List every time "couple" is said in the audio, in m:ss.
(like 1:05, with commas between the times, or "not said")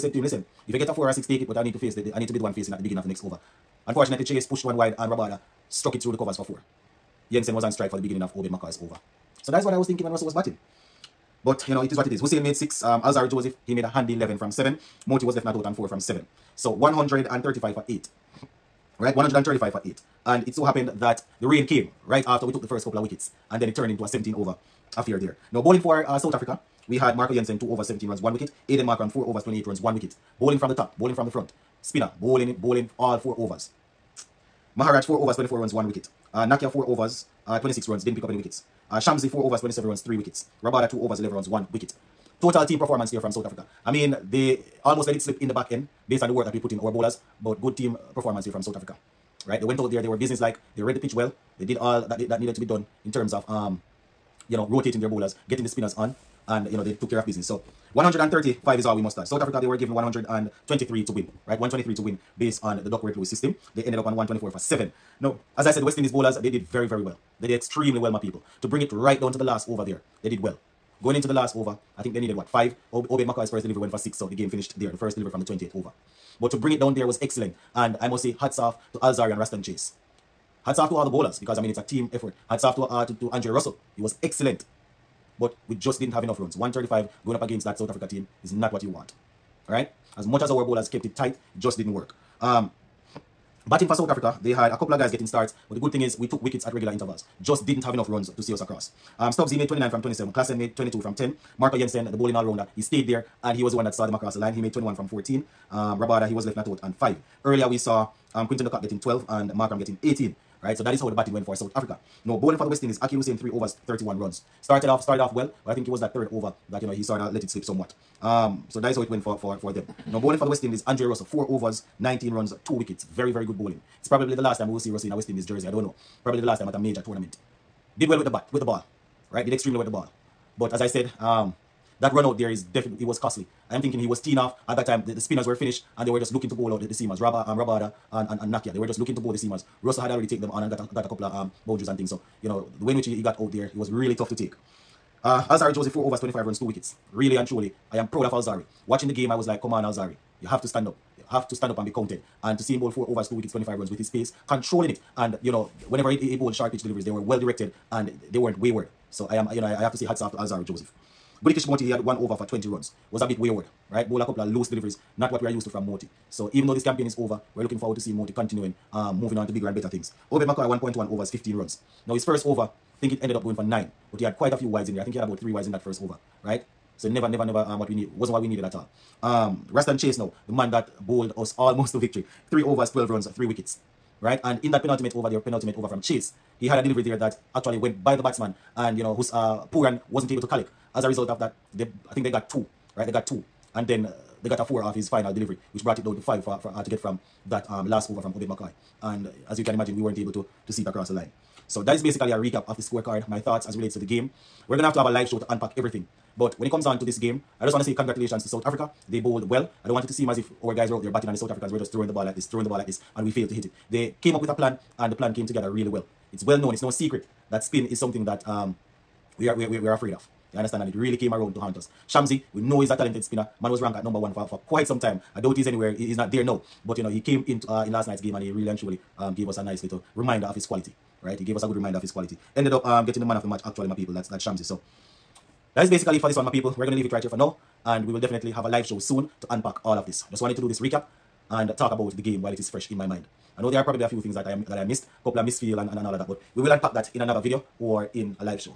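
0:22, 1:34, 2:21, 2:44, 4:05.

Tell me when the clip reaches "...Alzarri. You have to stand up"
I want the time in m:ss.
2:29.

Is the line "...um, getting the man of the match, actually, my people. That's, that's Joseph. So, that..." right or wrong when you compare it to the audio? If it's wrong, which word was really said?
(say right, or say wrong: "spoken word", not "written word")
wrong: "Shamsi", not "Joseph".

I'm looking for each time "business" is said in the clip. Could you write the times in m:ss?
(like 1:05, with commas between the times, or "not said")
0:50, 0:57.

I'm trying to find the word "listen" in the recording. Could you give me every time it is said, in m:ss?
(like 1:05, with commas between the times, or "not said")
0:00.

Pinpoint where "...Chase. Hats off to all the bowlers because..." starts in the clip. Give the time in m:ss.
1:19.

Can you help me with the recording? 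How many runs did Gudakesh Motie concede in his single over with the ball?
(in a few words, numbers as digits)
20.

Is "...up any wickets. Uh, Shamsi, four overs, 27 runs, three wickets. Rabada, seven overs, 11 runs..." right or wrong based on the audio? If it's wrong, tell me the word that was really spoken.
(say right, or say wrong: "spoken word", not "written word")
wrong: "two", not "seven".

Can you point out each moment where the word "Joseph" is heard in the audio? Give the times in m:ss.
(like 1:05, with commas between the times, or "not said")
0:13, 2:25, 2:40.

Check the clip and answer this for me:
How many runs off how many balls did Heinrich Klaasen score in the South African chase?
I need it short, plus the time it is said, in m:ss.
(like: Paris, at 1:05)
22 from 10, at 1:40.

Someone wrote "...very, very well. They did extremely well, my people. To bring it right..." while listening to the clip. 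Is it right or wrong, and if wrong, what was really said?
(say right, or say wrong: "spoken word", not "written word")
right.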